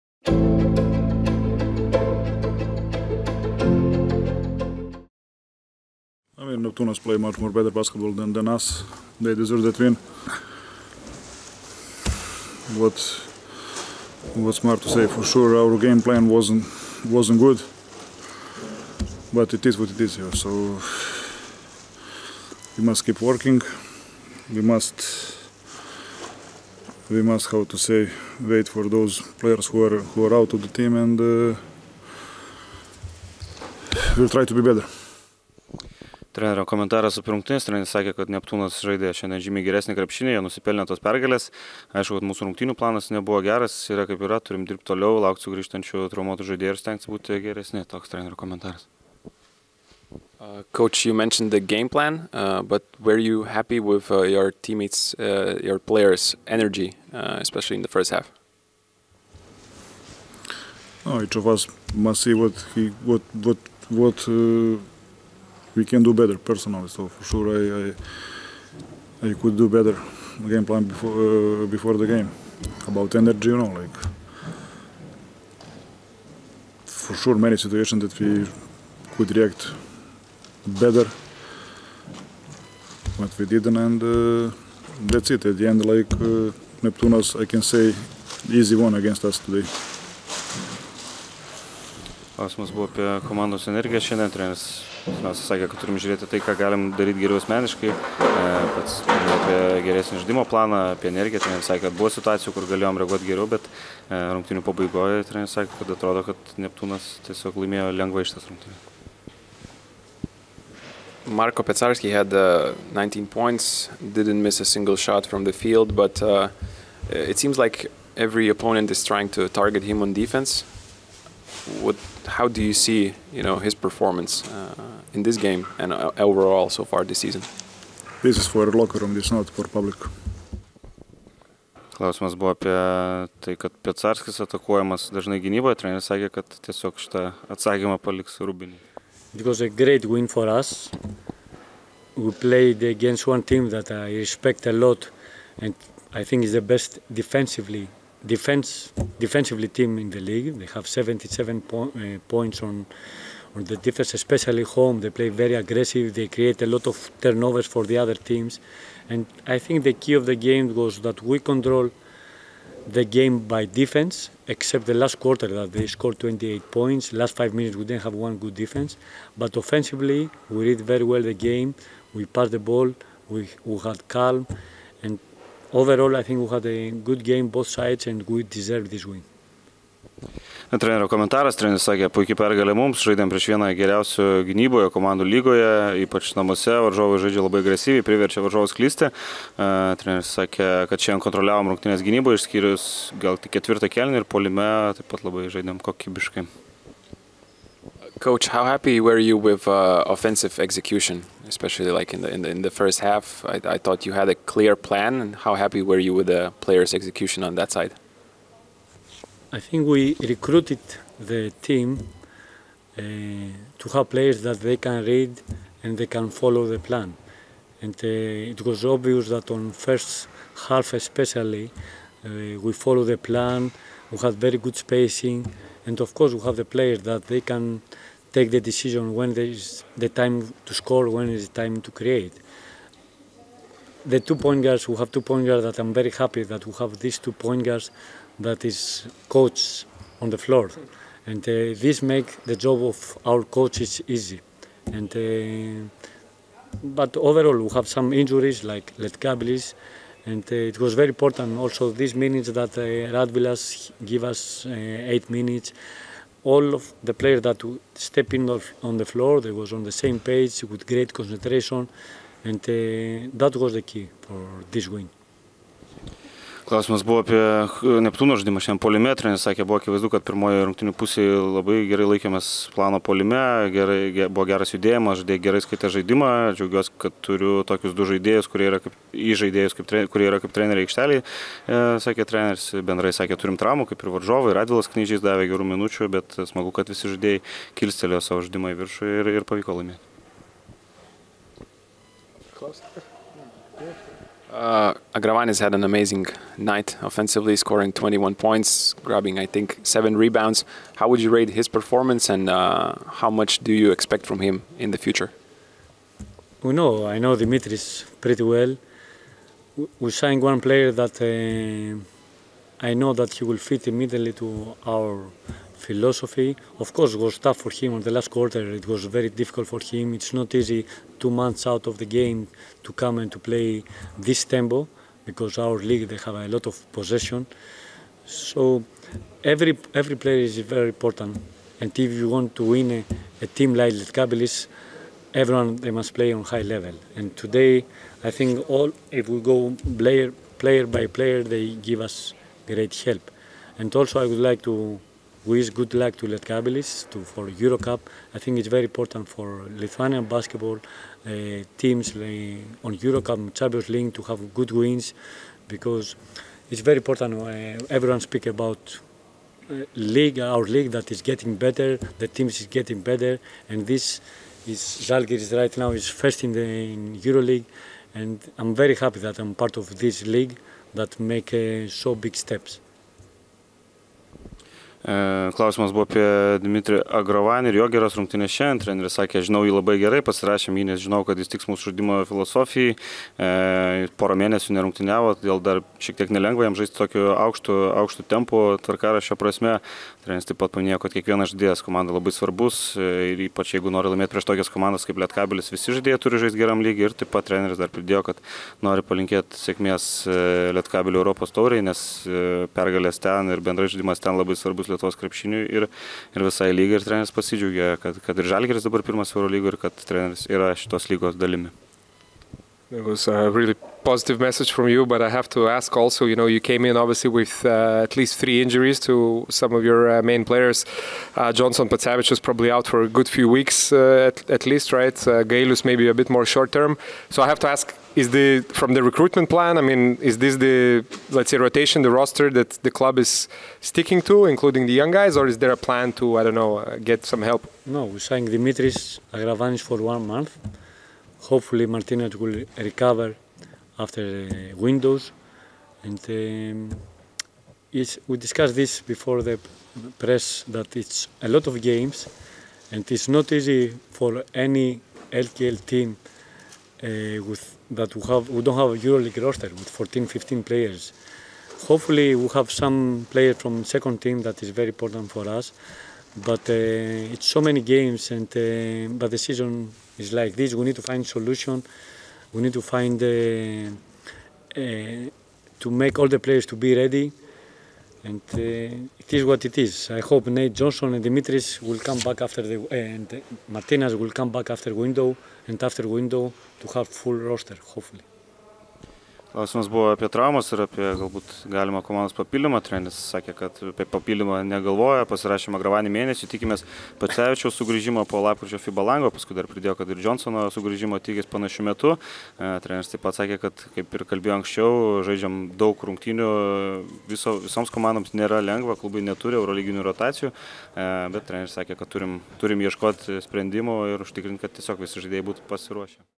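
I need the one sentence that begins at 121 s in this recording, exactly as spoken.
what, how do you see, you know, his performance uh, in this game and uh, overall so far this season?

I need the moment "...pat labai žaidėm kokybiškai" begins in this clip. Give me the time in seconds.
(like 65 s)
195 s.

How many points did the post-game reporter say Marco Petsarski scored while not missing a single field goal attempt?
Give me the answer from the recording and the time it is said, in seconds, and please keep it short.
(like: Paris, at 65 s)
19, at 112 s.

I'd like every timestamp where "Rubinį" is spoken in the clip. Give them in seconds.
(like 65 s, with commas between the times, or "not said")
138 s.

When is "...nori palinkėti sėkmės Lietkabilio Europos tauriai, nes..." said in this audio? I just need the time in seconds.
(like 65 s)
398 s.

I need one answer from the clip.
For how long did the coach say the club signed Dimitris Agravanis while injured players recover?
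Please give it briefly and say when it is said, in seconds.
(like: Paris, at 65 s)
1 month, at 440 s.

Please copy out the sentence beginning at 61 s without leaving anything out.
No, each of us must see what he, what, what, what.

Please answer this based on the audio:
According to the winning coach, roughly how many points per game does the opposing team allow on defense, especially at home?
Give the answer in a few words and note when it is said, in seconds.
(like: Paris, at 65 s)
77, at 150 s.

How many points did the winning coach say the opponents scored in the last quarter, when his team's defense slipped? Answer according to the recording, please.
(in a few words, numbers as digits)
28.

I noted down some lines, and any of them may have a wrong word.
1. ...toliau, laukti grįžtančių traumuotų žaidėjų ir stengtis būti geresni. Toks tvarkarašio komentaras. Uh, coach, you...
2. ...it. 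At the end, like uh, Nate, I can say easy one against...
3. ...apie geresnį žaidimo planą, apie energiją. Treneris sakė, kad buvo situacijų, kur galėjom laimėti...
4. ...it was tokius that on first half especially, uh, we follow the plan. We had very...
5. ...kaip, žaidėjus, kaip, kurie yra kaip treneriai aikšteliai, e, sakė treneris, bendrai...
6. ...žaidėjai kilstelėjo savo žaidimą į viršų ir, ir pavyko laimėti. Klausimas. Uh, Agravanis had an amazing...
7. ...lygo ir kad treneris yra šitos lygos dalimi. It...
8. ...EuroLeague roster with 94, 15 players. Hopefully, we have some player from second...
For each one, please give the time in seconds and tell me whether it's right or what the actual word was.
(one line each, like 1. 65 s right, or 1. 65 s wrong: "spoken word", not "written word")
1. 44 s wrong: "trenerio", not "tvarkarašio"
2. 85 s wrong: "Neptunas", not "Nate"
3. 99 s wrong: "reaguoti", not "laimėti"
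4. 218 s wrong: "obvious", not "tokius"
5. 278 s right
6. 287 s right
7. 409 s right
8. 459 s wrong: "14", not "94".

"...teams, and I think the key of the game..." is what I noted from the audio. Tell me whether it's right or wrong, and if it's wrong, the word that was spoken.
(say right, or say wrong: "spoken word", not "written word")
right.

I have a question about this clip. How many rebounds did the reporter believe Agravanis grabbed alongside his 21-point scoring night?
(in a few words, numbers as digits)
7.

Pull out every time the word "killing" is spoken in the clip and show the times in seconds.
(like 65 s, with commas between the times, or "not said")
not said.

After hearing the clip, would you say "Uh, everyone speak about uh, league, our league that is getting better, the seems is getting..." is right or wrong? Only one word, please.
wrong.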